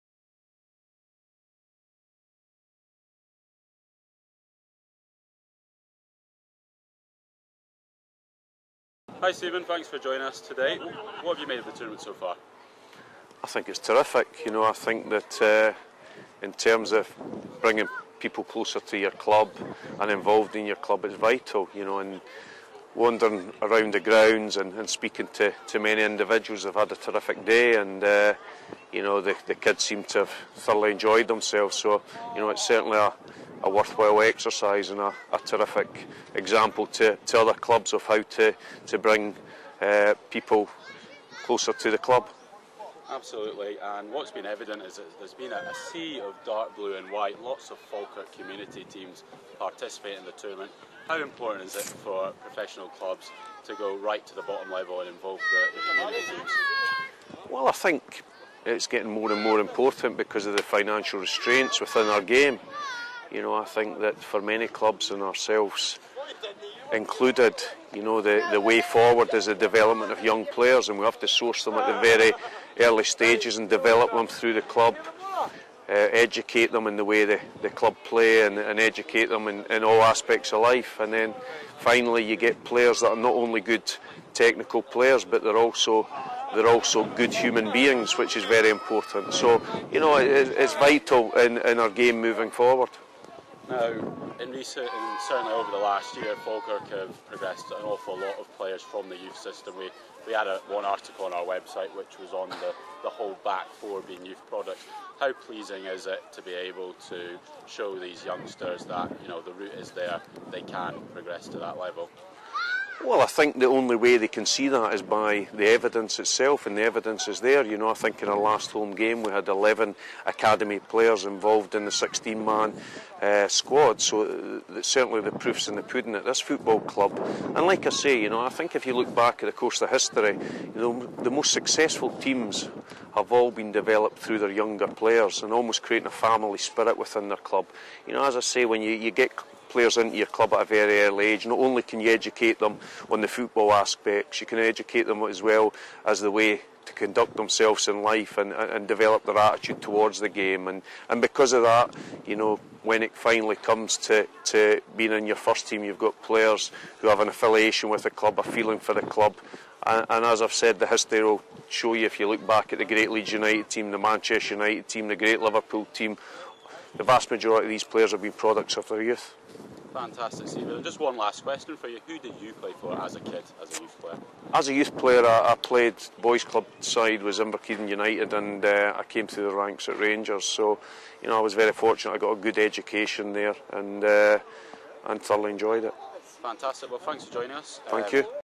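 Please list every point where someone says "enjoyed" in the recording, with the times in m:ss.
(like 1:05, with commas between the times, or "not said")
0:30, 3:05.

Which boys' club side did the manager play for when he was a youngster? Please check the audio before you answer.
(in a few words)
Inverkeithing United.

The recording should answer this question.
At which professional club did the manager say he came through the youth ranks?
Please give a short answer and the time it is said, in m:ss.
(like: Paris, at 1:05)
Rangers, at 2:59.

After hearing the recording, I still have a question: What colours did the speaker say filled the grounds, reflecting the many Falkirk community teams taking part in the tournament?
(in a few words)
Dark blue and white.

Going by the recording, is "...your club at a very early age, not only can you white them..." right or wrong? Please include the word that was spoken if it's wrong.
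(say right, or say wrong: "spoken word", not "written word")
wrong: "educate", not "white".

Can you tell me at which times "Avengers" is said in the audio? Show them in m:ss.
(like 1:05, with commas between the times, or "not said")
not said.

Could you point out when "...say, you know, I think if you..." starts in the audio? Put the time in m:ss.
2:07.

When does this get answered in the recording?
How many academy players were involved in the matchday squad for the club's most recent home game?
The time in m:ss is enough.
1:59.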